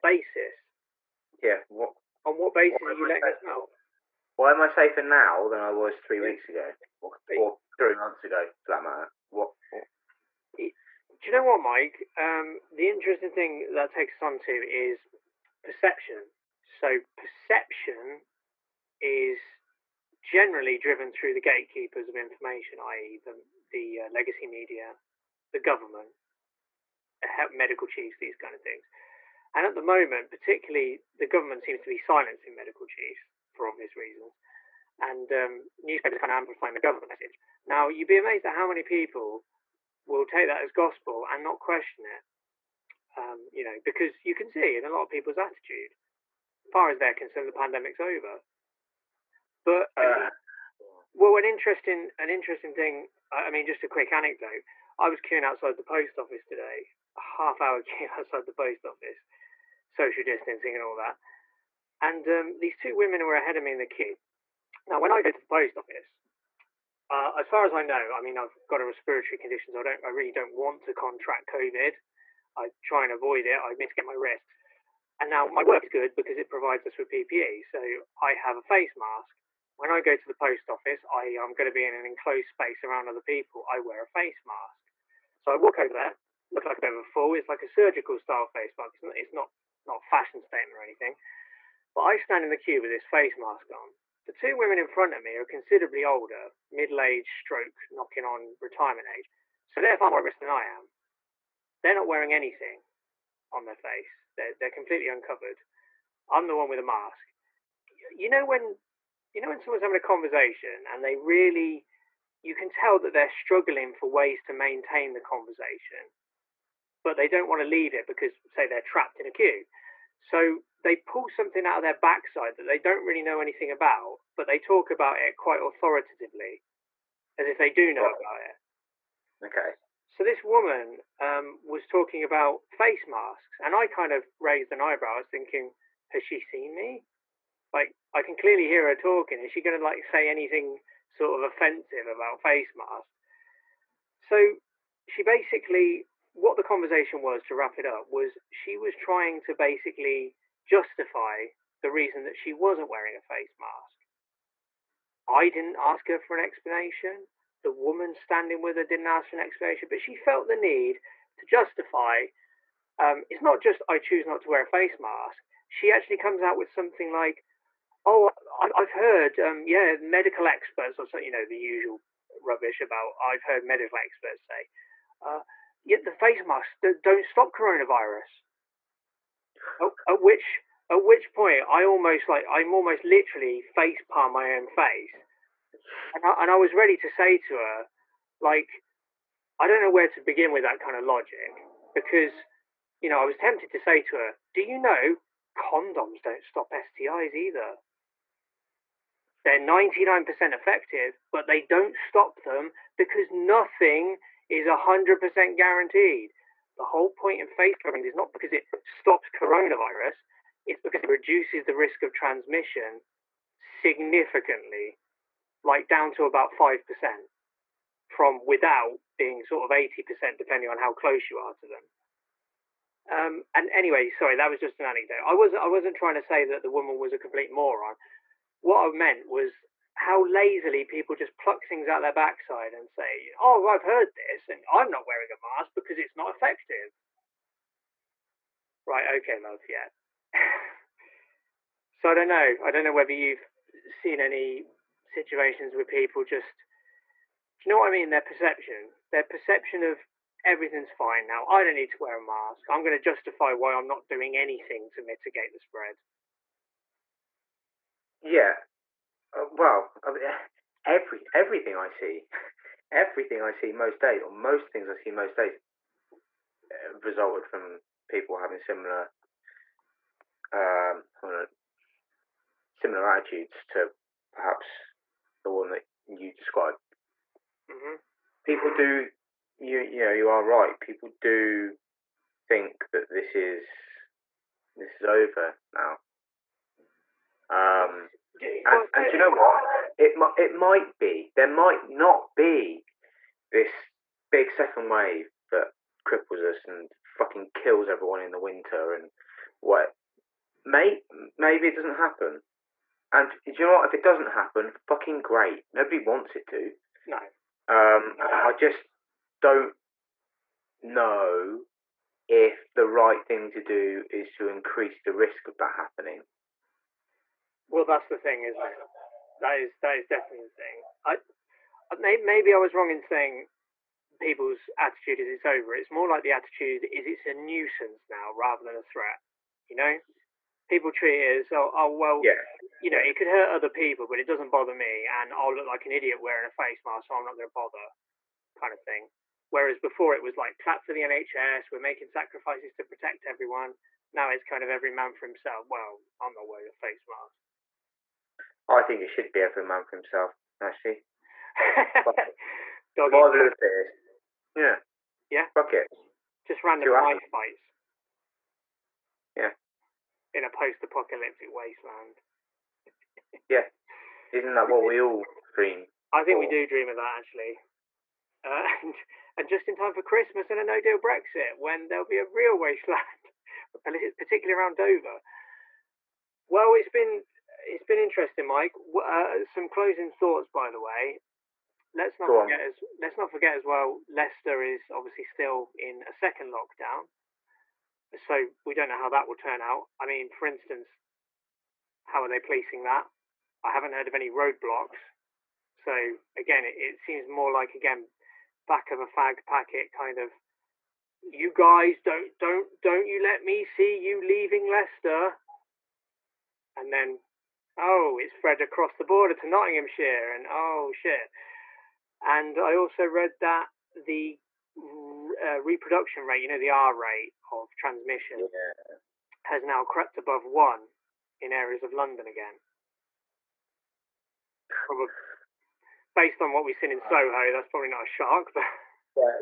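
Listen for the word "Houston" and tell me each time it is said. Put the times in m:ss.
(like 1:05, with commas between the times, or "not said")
not said.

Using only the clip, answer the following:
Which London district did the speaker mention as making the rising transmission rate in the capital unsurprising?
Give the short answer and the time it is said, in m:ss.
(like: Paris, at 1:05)
Soho, at 7:06.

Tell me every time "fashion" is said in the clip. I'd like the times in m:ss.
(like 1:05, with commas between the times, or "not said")
1:30.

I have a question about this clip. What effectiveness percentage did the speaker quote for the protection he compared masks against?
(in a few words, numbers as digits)
99%.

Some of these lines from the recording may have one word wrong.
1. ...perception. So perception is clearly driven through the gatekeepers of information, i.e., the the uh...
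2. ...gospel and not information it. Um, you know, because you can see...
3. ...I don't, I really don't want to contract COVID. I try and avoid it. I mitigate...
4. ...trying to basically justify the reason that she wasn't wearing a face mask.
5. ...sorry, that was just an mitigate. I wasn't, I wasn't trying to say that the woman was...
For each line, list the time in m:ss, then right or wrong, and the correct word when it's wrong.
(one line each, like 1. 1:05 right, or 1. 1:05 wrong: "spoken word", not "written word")
1. 0:15 wrong: "generally", not "clearly"
2. 0:40 wrong: "question", not "information"
3. 1:09 right
4. 2:28 right
5. 3:44 wrong: "anecdote", not "mitigate".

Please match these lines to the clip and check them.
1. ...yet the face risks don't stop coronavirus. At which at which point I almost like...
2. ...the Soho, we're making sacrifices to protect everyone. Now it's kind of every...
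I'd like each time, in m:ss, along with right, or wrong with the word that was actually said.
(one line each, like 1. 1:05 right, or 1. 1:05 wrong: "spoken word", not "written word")
1. 2:55 wrong: "masks", not "risks"
2. 5:40 wrong: "NHS", not "Soho".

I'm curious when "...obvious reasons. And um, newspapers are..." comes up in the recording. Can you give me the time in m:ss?
0:33.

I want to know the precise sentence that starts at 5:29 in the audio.
You know, people treat it as oh, oh well, yeah.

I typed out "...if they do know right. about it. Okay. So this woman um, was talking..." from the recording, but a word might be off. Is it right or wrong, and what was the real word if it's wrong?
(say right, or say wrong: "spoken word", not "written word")
right.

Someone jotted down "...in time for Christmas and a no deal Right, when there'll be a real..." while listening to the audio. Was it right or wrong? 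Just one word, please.
wrong.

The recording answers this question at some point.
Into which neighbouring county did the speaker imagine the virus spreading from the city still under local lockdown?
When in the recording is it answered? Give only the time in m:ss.
6:49.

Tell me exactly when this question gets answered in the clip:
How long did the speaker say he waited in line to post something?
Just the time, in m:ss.
0:57.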